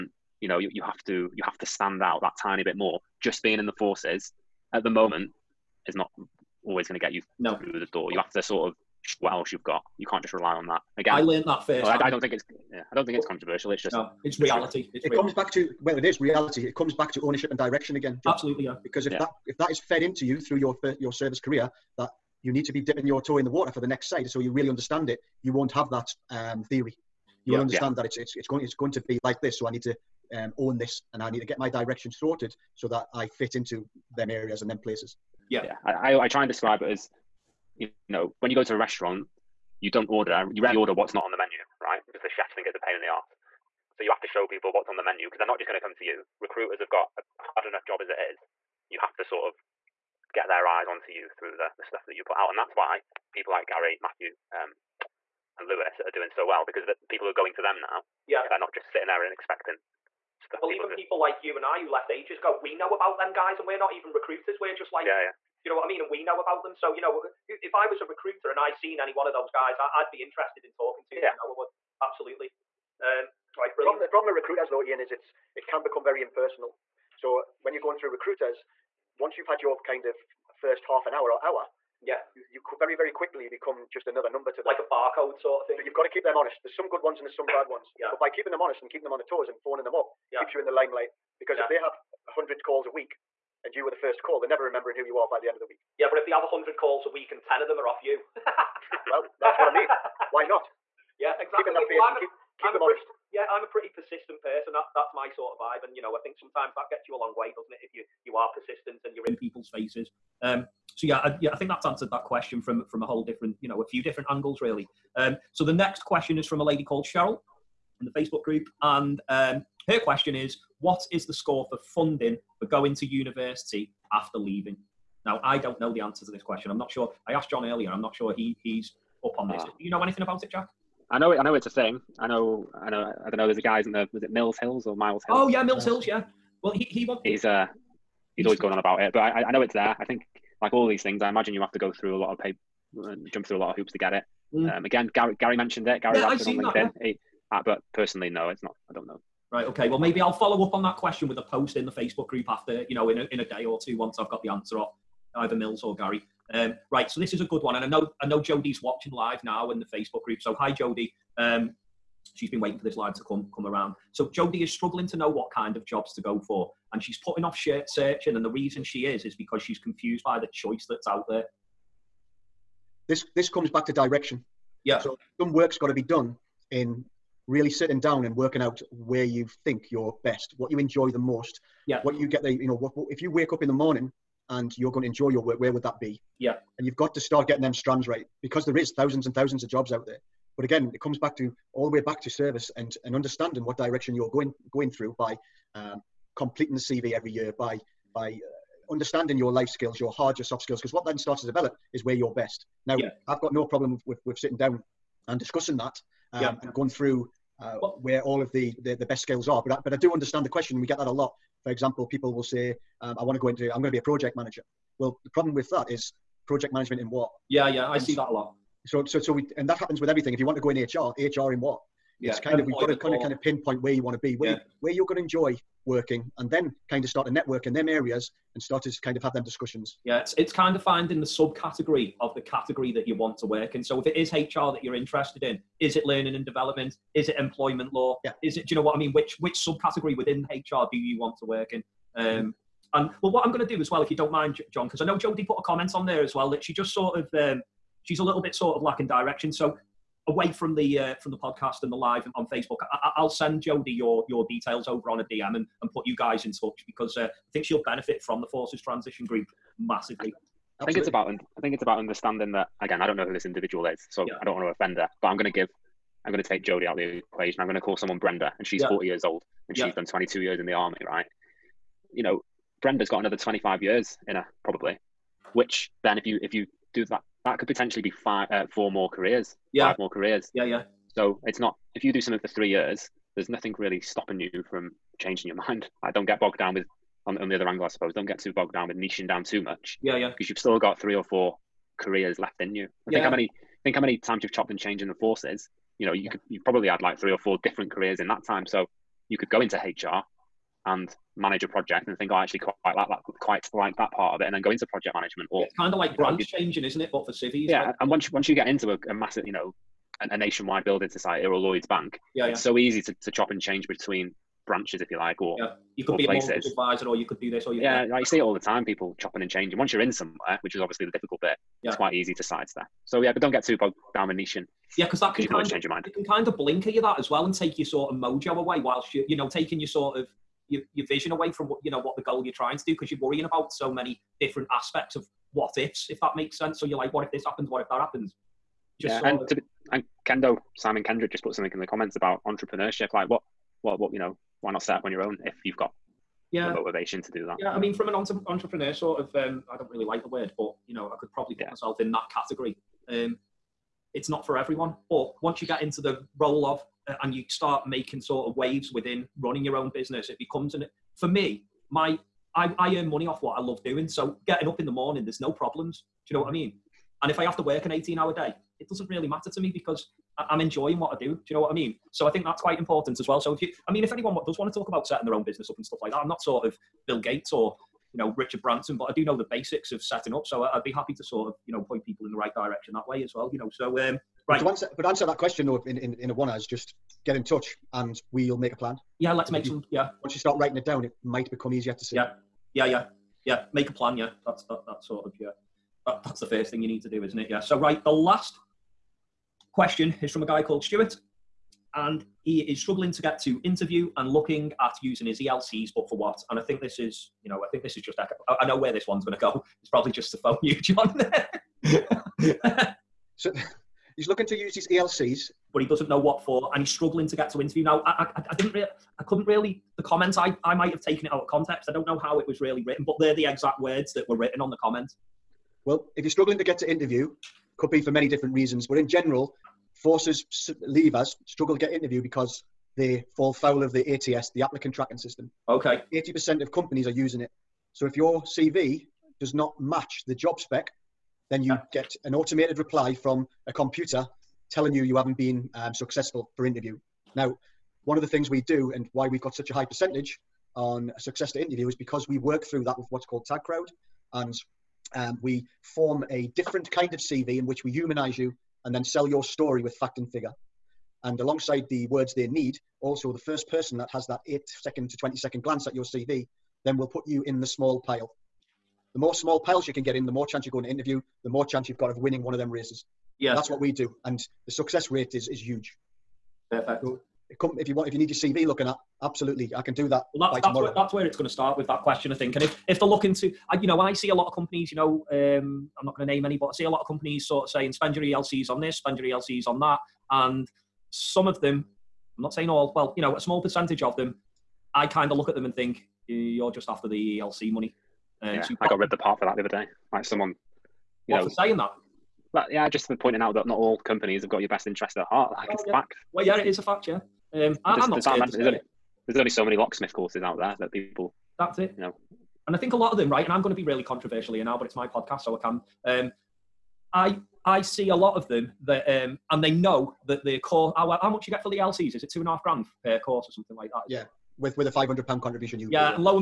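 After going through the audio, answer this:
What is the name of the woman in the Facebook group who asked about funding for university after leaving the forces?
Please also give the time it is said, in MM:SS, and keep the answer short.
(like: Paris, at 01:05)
Cheryl, at 01:57.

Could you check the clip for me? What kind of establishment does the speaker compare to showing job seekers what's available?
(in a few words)
restaurant.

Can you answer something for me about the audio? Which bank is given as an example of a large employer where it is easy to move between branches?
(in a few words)
Lloyd's Bank.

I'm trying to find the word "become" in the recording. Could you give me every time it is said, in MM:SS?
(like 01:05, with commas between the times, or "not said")
01:15, 01:23, 06:00, 06:31.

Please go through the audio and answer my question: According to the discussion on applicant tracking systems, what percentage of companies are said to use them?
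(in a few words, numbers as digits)
80%.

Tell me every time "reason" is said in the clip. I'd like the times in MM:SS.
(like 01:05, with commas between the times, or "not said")
02:48, 07:08.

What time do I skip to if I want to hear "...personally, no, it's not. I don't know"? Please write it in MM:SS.
02:27.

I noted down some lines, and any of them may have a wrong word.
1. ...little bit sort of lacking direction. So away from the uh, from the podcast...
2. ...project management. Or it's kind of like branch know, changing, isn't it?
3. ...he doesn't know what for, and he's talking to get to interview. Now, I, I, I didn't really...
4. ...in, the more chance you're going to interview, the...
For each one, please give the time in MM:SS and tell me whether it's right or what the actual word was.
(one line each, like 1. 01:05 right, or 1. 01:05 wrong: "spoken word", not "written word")
1. 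04:08 right
2. 05:04 right
3. 06:55 wrong: "struggling", not "talking"
4. 07:50 right.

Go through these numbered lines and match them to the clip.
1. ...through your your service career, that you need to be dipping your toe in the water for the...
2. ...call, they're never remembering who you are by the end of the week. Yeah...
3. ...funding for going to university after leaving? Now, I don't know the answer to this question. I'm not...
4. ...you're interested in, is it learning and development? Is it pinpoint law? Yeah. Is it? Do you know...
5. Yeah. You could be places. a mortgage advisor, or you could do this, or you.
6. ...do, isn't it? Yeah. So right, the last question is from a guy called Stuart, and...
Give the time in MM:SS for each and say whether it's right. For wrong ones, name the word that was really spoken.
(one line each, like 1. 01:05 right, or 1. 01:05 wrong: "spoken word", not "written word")
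1. 00:20 right
2. 01:34 right
3. 02:01 right
4. 03:54 wrong: "employment", not "pinpoint"
5. 05:15 right
6. 06:37 right.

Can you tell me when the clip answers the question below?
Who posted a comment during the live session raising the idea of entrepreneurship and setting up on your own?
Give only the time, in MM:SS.
05:40.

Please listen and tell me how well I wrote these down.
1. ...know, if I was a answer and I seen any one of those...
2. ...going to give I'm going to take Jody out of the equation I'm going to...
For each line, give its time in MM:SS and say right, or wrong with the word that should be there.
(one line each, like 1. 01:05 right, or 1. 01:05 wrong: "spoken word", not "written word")
1. 01:07 wrong: "recruiter", not "answer"
2. 04:25 right.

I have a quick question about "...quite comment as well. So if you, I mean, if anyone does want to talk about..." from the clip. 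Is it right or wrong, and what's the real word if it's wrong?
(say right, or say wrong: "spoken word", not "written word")
wrong: "important", not "comment".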